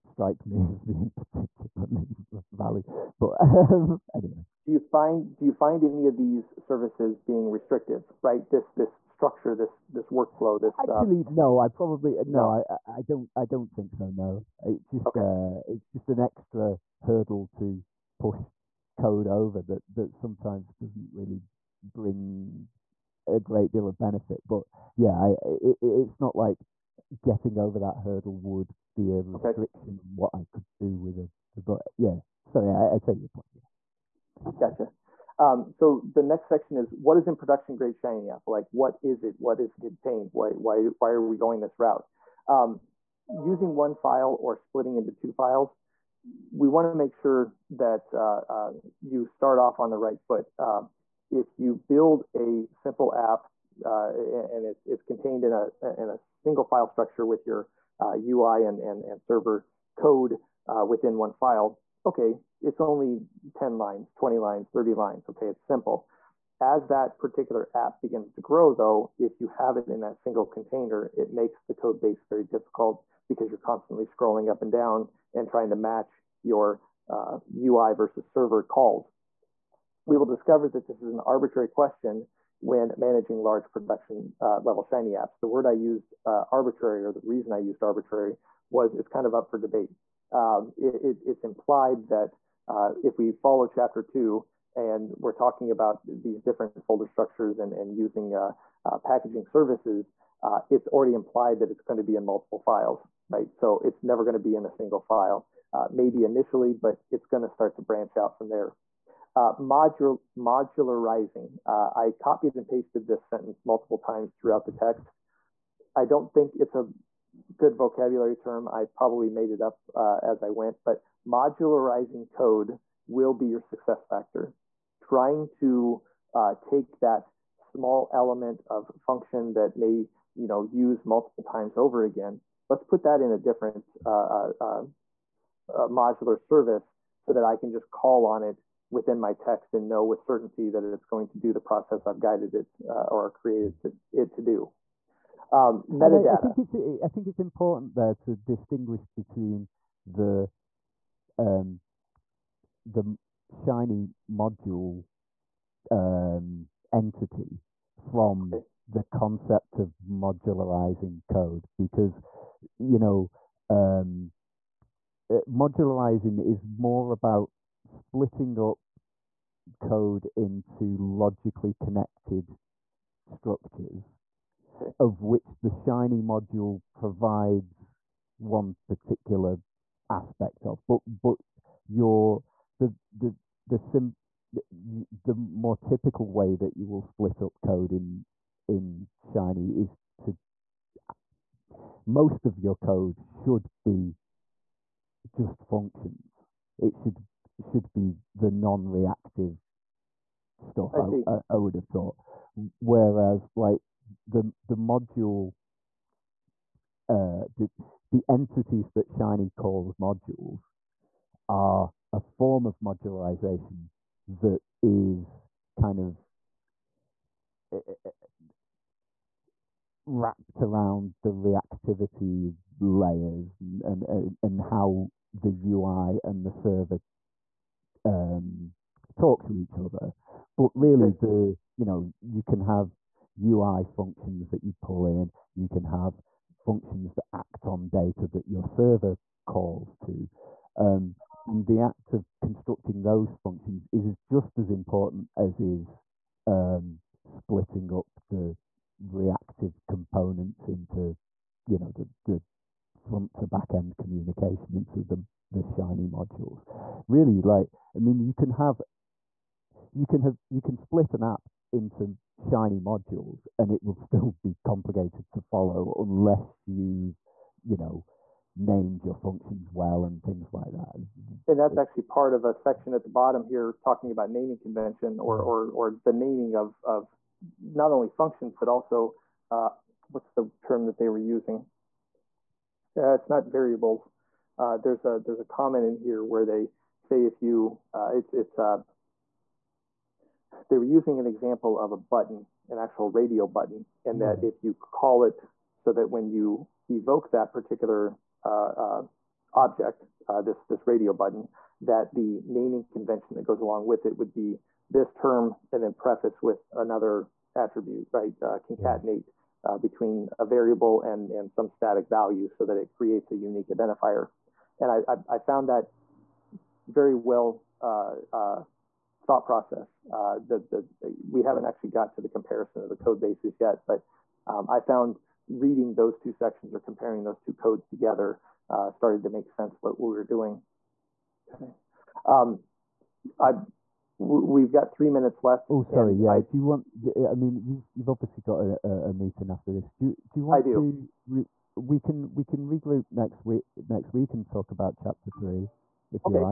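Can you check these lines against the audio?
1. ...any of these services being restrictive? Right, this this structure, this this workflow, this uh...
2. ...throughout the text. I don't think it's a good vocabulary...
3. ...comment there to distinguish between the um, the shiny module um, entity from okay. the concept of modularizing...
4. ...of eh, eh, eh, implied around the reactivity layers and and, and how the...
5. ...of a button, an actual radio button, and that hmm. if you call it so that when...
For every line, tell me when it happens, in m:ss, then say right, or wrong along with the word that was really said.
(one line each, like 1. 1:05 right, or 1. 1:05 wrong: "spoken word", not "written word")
1. 0:05 right
2. 1:54 right
3. 2:27 wrong: "important", not "comment"
4. 3:35 wrong: "wrapped", not "implied"
5. 4:51 right.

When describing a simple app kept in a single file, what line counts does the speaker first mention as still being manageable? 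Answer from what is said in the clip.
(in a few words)
10 lines.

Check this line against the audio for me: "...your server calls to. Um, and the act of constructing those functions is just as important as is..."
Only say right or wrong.
right.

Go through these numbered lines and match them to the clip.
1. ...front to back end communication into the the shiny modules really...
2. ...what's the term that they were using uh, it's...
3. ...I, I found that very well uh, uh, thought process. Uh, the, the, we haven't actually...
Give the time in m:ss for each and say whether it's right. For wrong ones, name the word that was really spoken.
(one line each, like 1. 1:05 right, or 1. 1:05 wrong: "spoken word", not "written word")
1. 4:12 right
2. 4:40 right
3. 5:15 right.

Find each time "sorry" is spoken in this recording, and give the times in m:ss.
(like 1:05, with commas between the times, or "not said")
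0:32, 5:35.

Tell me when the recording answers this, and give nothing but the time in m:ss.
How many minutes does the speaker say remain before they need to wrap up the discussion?
5:34.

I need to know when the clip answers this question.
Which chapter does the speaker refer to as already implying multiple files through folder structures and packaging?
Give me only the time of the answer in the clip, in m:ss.
1:33.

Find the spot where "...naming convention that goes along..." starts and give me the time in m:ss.
5:02.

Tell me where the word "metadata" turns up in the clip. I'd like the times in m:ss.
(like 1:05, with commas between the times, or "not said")
2:25.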